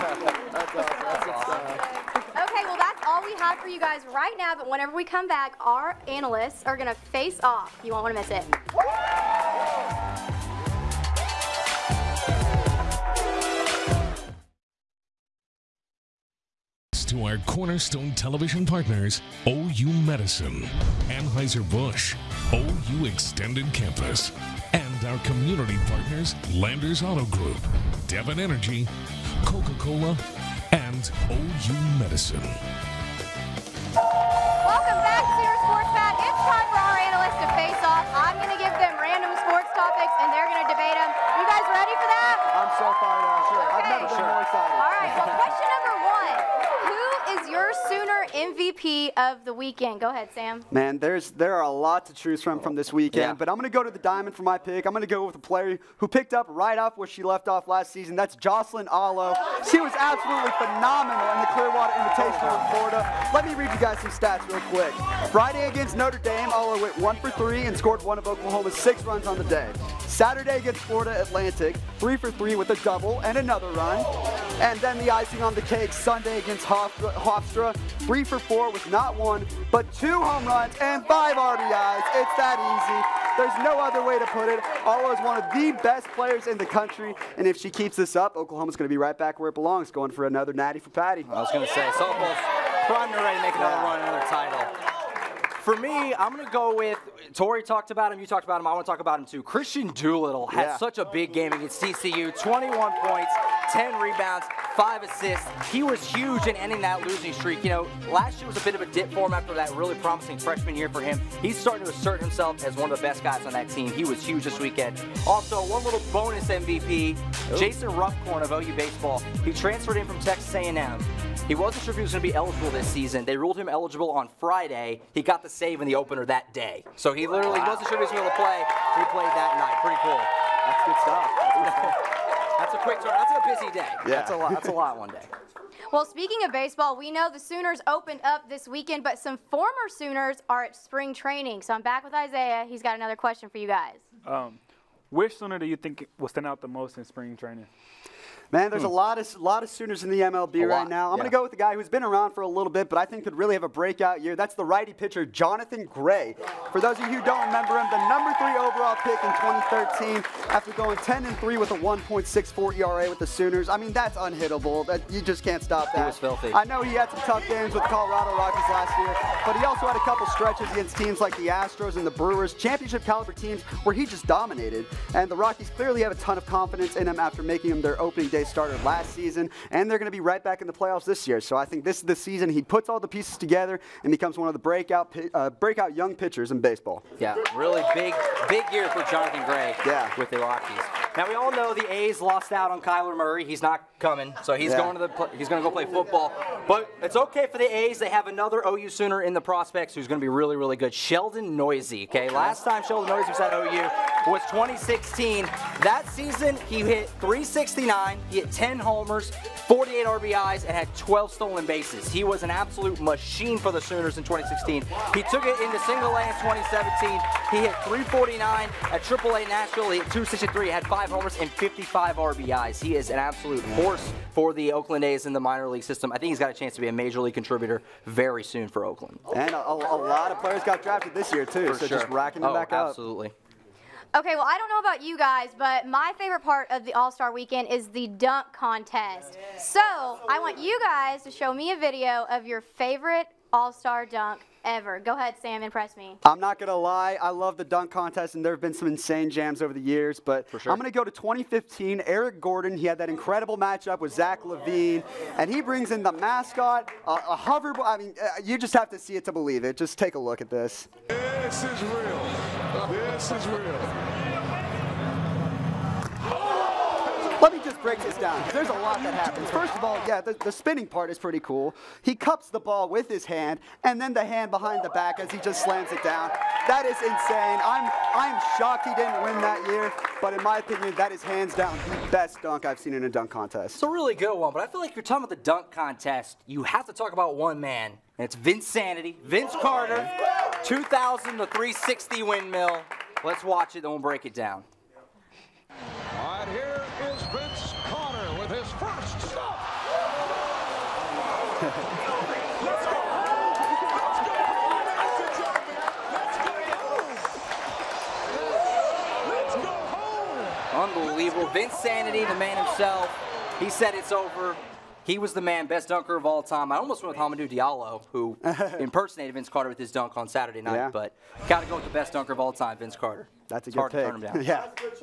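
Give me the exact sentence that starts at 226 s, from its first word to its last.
I think he's got a chance to be a major league contributor very soon for Oakland.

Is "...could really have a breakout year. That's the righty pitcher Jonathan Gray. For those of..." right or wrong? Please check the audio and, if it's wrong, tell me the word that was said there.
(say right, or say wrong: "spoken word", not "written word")
right.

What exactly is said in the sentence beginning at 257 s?
I mean, uh, you just have to see it to believe it.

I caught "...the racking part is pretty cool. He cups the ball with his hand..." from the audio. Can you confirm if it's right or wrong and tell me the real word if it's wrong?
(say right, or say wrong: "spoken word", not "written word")
wrong: "spinning", not "racking".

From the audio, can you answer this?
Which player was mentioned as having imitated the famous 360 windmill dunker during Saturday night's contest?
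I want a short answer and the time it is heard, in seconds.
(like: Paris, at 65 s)
Hamidou Diallo, at 317 s.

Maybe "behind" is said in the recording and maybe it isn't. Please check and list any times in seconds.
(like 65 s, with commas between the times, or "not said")
274 s.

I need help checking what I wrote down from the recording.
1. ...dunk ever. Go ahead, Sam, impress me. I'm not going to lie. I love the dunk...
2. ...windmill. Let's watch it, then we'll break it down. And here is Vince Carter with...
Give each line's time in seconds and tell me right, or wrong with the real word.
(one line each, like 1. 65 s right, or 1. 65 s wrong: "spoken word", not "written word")
1. 244 s right
2. 292 s right.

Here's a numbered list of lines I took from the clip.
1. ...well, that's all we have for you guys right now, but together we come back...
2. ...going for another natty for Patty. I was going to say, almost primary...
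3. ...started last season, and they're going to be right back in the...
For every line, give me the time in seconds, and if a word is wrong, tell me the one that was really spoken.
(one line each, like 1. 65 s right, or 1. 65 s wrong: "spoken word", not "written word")
1. 2 s wrong: "whenever", not "together"
2. 89 s right
3. 178 s right.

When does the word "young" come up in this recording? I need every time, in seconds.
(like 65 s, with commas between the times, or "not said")
185 s.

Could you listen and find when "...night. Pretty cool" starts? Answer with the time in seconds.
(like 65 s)
129 s.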